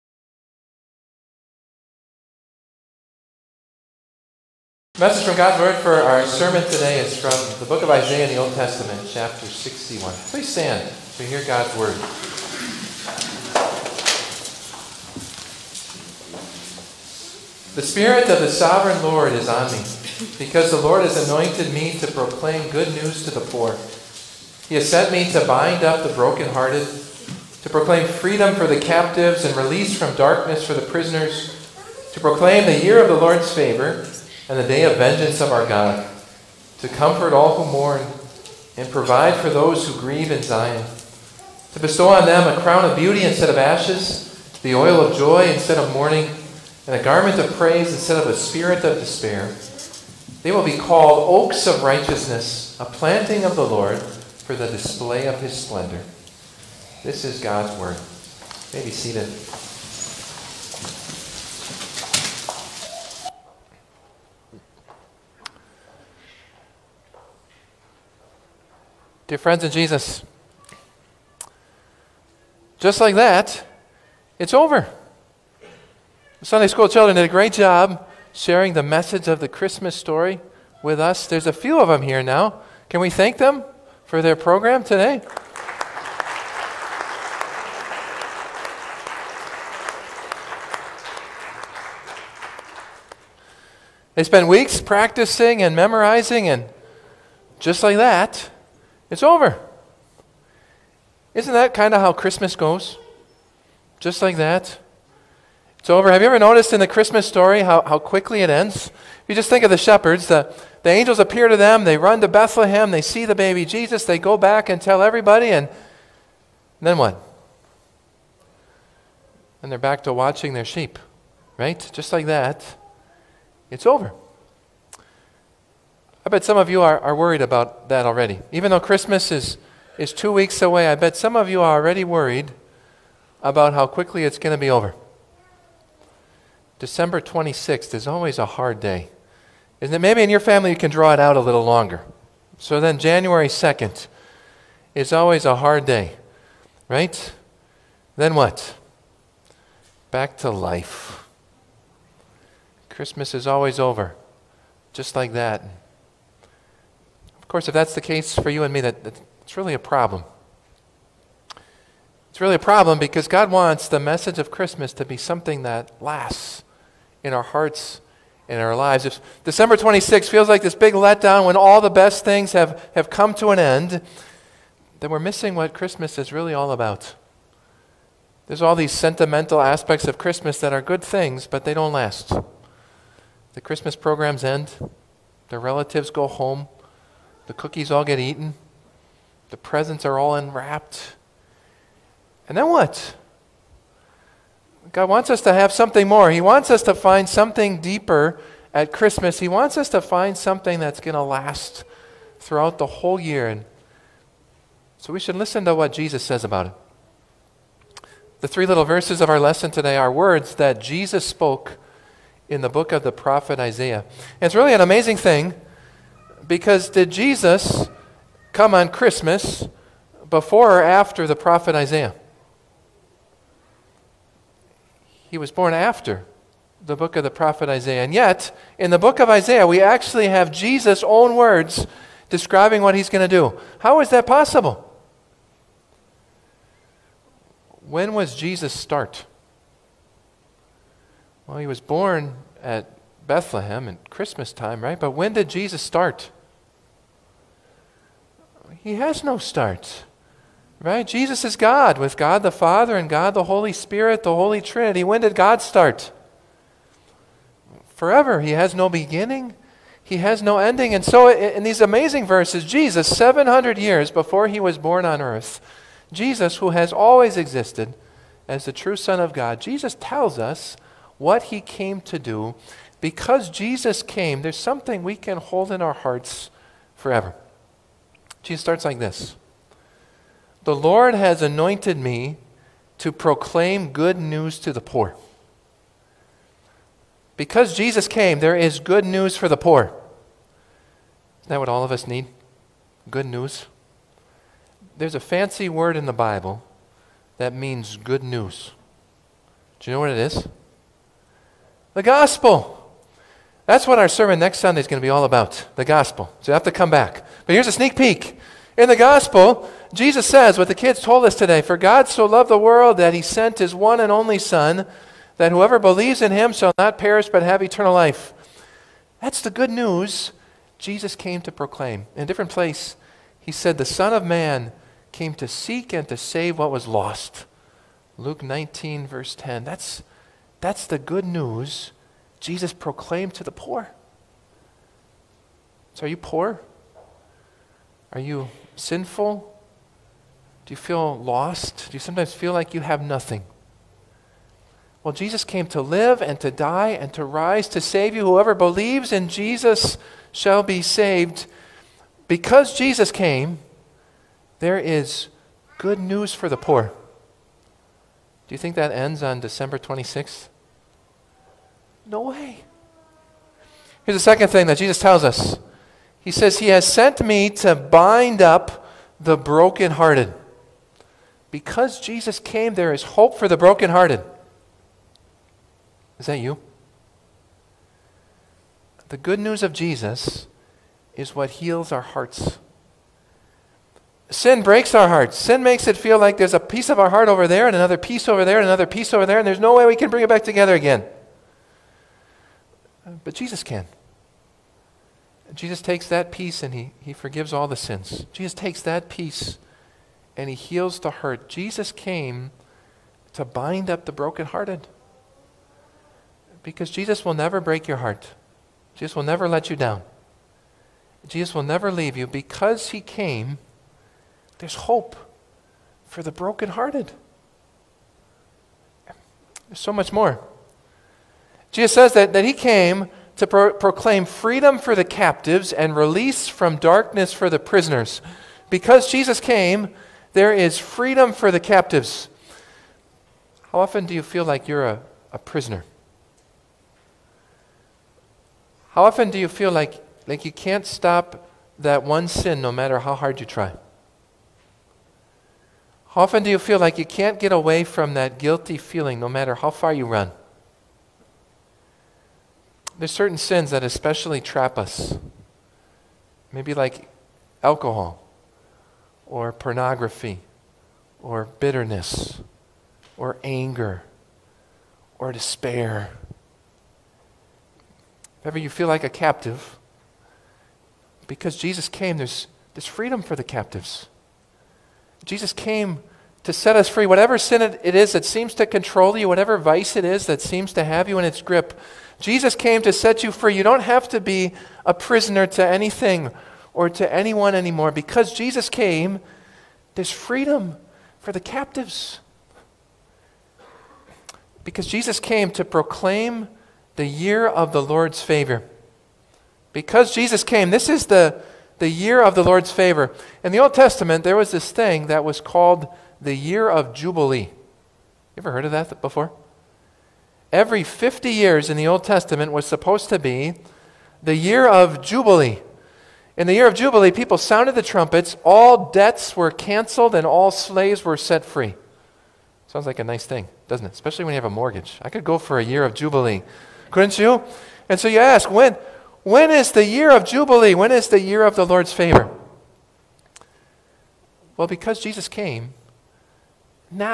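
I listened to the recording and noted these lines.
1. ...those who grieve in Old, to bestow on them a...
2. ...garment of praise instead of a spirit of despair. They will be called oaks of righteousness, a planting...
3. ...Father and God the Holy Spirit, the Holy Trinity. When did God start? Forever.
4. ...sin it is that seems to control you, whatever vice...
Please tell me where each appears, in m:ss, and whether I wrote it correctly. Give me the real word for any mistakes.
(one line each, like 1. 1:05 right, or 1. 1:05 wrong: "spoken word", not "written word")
1. 0:39 wrong: "Zion", not "Old"
2. 0:47 right
3. 4:12 right
4. 7:57 right.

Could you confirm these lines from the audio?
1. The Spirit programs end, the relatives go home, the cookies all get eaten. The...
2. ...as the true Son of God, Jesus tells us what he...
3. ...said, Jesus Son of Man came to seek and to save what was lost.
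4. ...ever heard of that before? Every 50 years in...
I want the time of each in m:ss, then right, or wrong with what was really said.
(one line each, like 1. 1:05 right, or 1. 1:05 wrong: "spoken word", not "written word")
1. 3:03 wrong: "Christmas", not "Spirit"
2. 4:28 right
3. 5:23 wrong: "The", not "Jesus"
4. 8:28 right.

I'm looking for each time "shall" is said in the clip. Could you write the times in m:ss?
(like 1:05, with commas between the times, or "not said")
5:16, 5:50.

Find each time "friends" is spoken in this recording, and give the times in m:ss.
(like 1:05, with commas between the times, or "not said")
1:09.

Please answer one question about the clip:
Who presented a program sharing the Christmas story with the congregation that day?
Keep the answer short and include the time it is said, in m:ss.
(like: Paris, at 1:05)
Sunday school children, at 1:16.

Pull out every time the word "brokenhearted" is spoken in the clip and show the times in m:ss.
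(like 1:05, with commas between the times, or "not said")
0:26, 6:09, 6:13, 6:44, 6:56.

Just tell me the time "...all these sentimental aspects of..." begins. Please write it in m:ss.
2:58.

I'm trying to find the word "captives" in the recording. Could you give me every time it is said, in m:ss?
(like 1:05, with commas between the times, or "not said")
0:28, 7:05, 7:11, 7:49, 7:53, 8:11.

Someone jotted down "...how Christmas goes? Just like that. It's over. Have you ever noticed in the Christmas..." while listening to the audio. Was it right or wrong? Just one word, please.
right.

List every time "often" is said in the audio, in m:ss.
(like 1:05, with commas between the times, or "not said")
7:13, 7:19, 7:26.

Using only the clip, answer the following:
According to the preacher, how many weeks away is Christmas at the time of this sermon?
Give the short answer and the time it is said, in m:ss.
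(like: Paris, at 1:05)
2, at 2:10.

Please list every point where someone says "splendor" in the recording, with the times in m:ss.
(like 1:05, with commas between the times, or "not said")
0:55.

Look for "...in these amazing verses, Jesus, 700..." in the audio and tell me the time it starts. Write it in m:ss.
4:21.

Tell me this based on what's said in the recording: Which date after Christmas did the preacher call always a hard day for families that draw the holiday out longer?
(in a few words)
January 2nd.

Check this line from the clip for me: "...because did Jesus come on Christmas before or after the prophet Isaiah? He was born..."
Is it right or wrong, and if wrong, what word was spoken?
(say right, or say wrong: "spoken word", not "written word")
right.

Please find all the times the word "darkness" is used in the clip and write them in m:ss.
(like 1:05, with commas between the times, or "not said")
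0:30, 7:06.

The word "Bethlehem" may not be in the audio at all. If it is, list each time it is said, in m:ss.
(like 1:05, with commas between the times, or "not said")
1:52, 4:03.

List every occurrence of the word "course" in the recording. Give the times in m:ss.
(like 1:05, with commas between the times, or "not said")
2:37.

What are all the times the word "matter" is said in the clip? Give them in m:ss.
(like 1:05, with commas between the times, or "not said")
7:22, 7:29.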